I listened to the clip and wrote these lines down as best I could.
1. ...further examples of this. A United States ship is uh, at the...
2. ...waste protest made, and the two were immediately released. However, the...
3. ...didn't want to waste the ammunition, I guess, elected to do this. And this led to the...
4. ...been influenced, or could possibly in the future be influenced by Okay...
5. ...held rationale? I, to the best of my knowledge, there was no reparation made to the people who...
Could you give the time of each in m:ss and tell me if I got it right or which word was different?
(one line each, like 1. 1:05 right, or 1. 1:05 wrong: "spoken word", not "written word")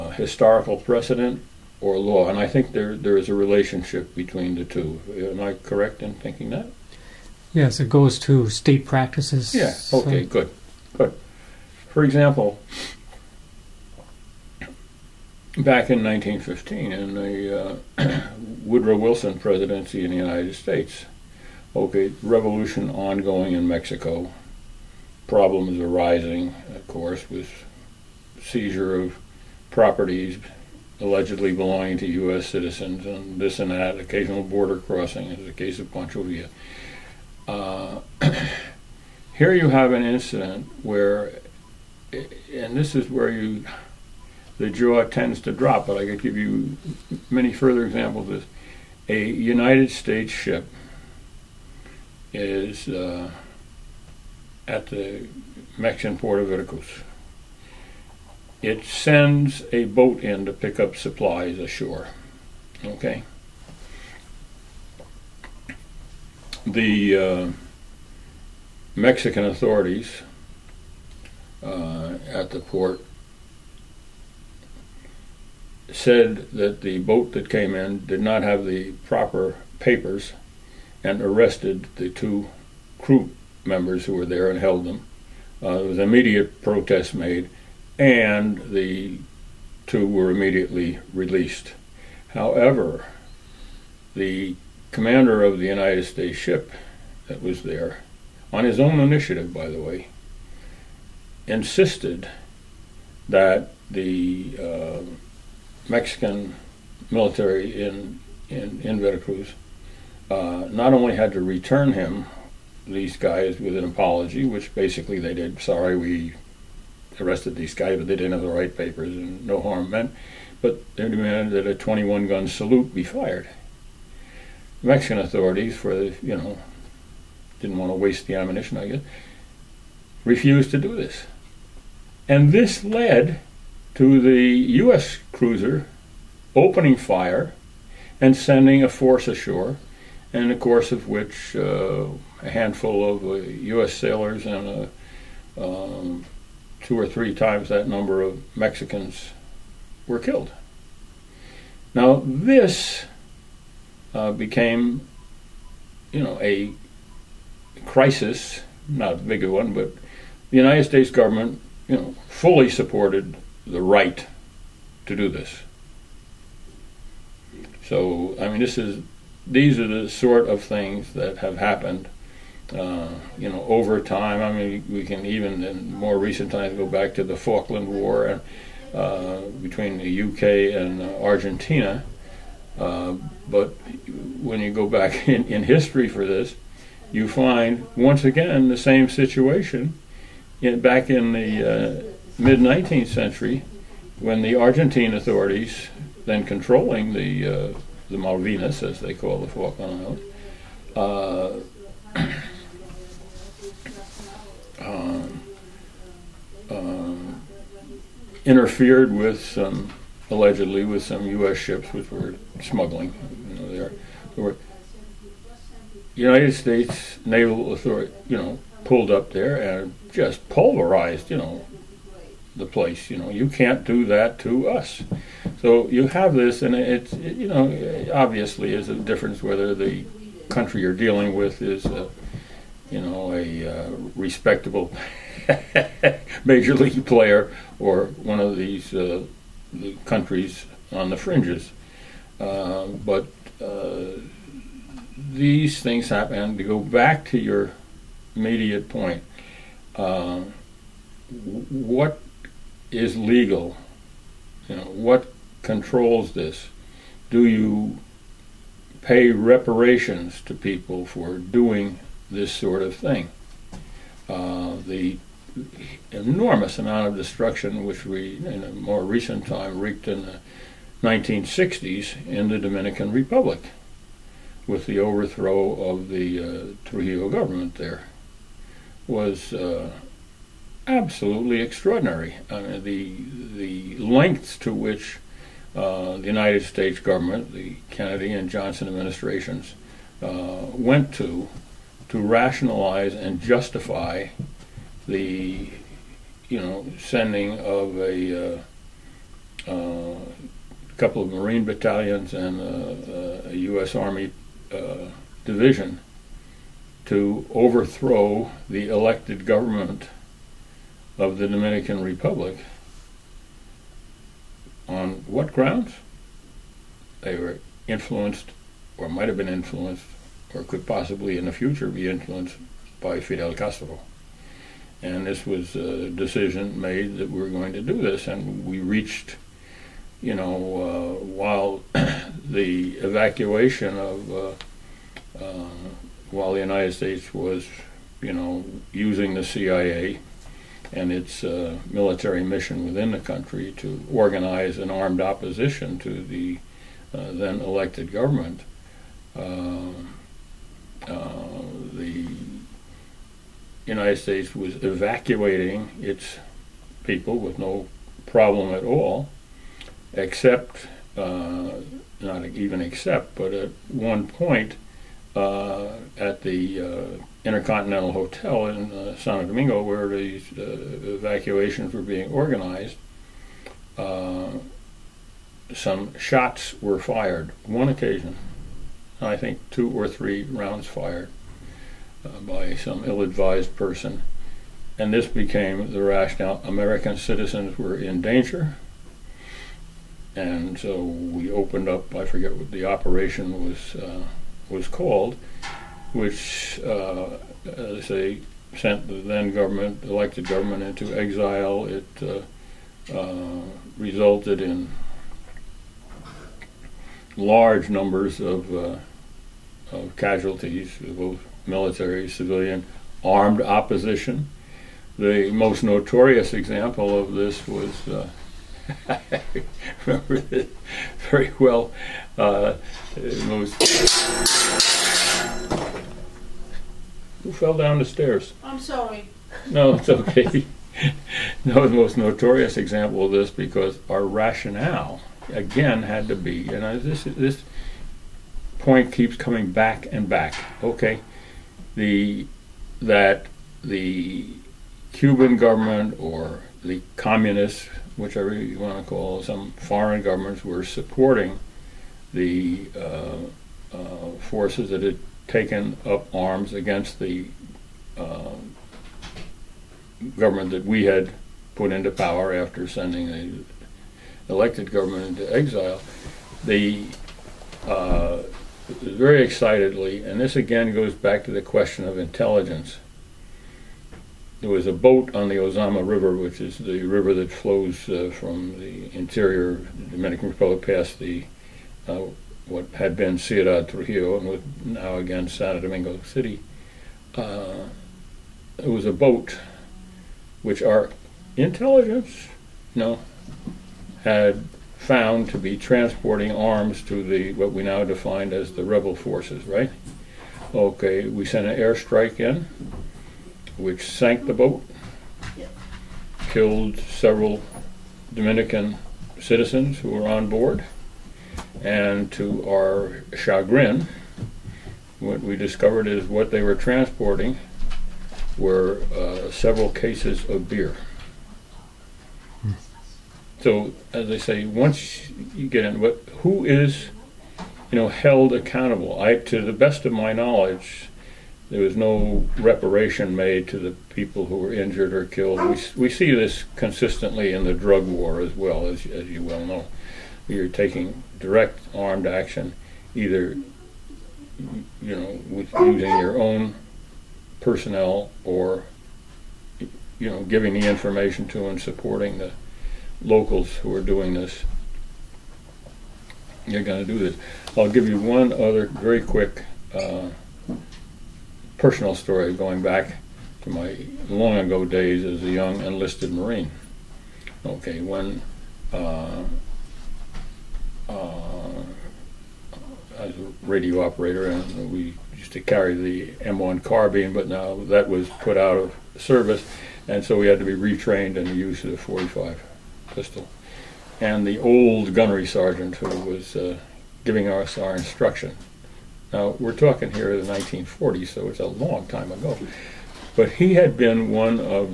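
1. 0:47 right
2. 1:25 wrong: "immediate", not "waste"
3. 2:07 wrong: "refused", not "elected"
4. 5:19 wrong: "Fidel", not "Okay"
5. 8:48 wrong: "accountable", not "rationale".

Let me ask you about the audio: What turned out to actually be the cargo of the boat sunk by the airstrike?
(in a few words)
beer.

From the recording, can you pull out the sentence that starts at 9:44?
And the old gunnery sergeant who was uh, giving us our instruction.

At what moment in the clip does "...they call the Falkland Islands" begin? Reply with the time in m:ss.
3:18.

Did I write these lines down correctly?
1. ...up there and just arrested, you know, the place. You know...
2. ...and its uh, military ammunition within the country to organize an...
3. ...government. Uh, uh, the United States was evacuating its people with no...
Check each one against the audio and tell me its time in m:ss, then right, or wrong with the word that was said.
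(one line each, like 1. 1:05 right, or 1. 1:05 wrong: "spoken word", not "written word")
1. 3:39 wrong: "pulverized", not "arrested"
2. 5:40 wrong: "mission", not "ammunition"
3. 5:48 right.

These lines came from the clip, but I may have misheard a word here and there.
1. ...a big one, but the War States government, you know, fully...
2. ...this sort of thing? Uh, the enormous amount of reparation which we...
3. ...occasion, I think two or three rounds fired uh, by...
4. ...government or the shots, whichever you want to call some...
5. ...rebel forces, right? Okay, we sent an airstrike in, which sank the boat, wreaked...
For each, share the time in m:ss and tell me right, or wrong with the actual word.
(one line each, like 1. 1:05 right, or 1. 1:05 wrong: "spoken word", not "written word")
1. 2:39 wrong: "United", not "War"
2. 4:22 wrong: "destruction", not "reparation"
3. 6:17 right
4. 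7:25 wrong: "communists", not "shots"
5. 8:18 wrong: "killed", not "wreaked".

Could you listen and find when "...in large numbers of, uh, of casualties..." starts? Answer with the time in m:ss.
6:44.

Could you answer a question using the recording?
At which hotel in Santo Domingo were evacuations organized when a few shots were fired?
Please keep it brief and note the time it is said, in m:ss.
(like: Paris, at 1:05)
Intercontinental Hotel, at 6:07.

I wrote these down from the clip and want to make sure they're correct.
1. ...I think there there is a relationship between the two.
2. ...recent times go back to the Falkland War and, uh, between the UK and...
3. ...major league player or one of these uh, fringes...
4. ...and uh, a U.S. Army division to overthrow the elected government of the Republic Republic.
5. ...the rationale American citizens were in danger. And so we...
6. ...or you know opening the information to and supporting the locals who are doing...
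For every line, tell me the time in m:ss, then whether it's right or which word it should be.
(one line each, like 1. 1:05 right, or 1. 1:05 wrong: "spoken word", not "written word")
1. 0:02 right
2. 2:56 right
3. 3:56 wrong: "countries", not "fringes"
4. 5:02 wrong: "Dominican", not "Republic"
5. 6:25 right
6. 9:08 wrong: "giving", not "opening".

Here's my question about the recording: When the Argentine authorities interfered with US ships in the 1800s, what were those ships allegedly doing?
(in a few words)
smuggling.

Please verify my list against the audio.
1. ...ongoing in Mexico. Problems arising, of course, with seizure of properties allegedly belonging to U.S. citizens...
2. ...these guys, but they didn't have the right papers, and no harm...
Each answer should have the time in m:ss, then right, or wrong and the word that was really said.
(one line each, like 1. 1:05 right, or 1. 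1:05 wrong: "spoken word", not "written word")
1. 0:22 right
2. 1:57 right.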